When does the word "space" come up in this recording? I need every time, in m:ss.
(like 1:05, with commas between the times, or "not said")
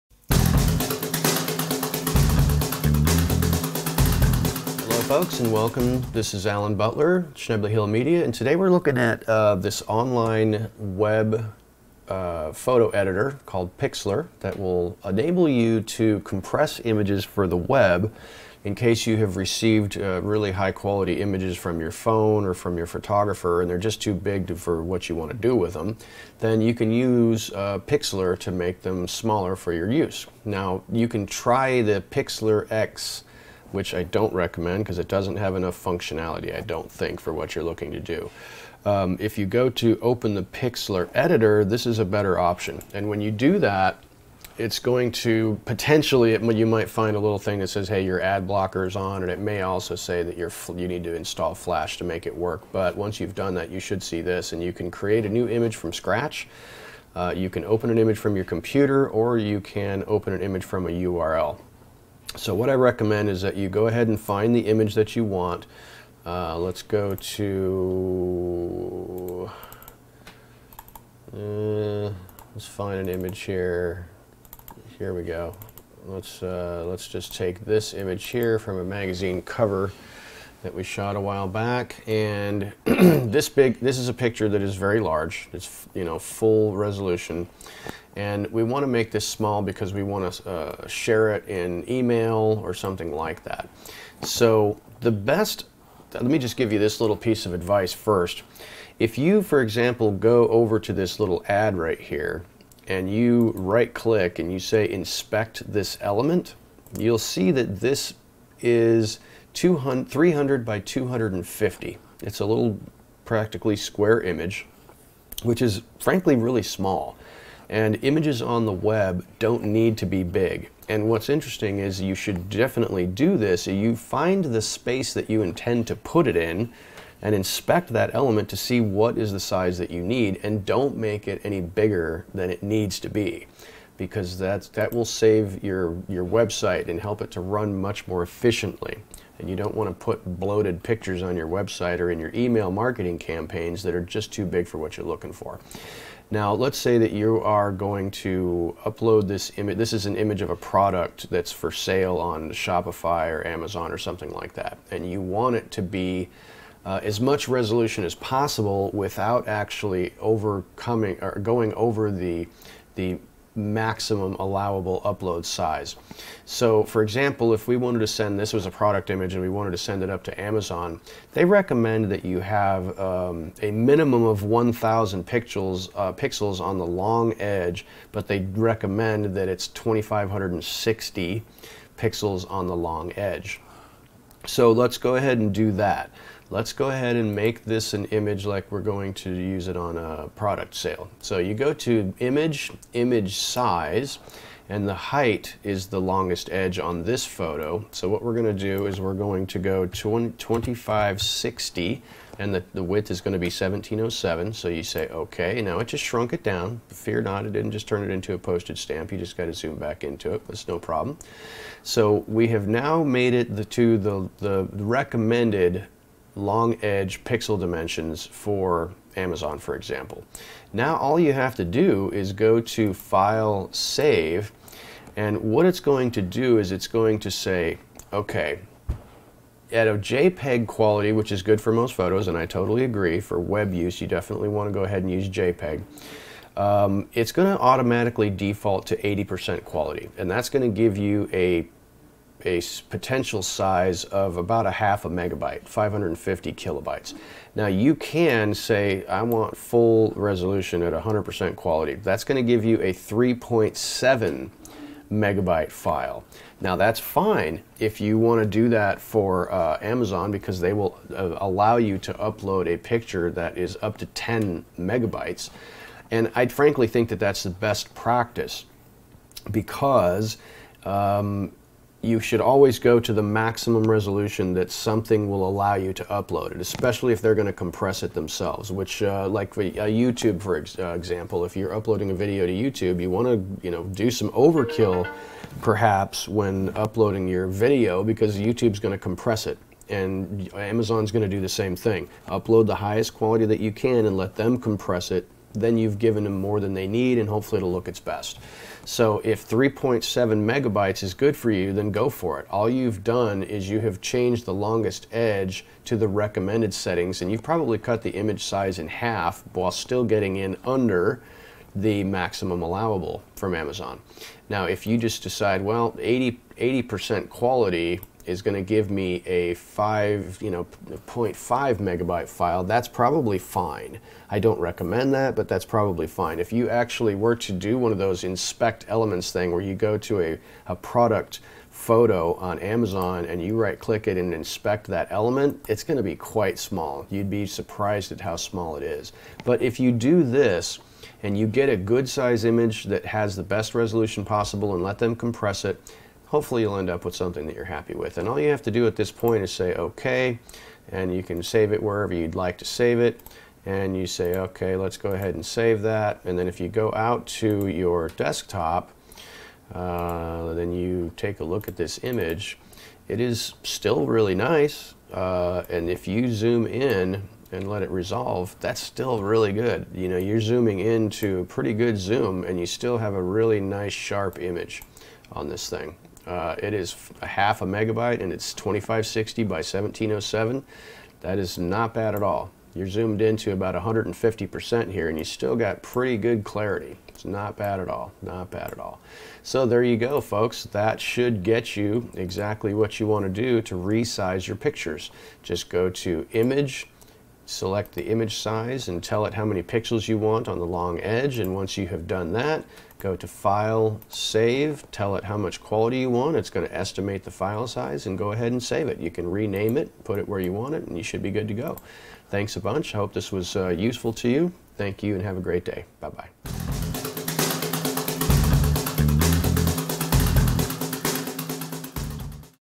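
2:04.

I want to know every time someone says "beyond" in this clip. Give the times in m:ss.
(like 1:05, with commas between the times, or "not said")
not said.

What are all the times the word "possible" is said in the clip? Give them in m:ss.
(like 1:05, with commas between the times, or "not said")
2:38, 5:44.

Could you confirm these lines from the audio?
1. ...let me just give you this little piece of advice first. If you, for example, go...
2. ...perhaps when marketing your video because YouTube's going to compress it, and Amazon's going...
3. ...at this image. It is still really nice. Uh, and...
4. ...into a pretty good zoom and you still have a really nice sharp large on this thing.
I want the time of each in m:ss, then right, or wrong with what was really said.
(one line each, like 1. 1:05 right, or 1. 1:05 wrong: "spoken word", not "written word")
1. 1:36 right
2. 4:45 wrong: "uploading", not "marketing"
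3. 6:01 right
4. 6:10 wrong: "image", not "large".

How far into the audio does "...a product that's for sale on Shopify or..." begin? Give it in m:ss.
2:30.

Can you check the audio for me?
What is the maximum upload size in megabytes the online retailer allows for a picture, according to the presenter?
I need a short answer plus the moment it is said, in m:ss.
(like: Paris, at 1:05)
10 megabytes, at 4:24.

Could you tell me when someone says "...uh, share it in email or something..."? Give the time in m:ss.
1:30.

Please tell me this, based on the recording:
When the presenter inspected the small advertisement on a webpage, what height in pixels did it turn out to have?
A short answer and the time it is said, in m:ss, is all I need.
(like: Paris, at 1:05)
250, at 1:50.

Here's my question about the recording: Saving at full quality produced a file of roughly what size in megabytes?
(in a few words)
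3.7 megabytes.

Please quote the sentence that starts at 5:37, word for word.
You'd be surprised at how small it is.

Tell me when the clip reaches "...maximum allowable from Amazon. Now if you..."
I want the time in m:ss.
5:12.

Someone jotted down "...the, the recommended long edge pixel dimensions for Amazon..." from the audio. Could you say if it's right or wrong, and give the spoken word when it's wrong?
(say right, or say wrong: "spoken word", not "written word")
right.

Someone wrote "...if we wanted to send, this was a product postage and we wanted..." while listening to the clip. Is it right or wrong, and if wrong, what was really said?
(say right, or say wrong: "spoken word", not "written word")
wrong: "image", not "postage".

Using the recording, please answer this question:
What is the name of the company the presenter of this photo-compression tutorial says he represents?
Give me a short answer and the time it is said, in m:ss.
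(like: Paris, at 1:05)
Schnebly Hill Media, at 0:07.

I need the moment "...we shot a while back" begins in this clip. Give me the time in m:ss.
1:20.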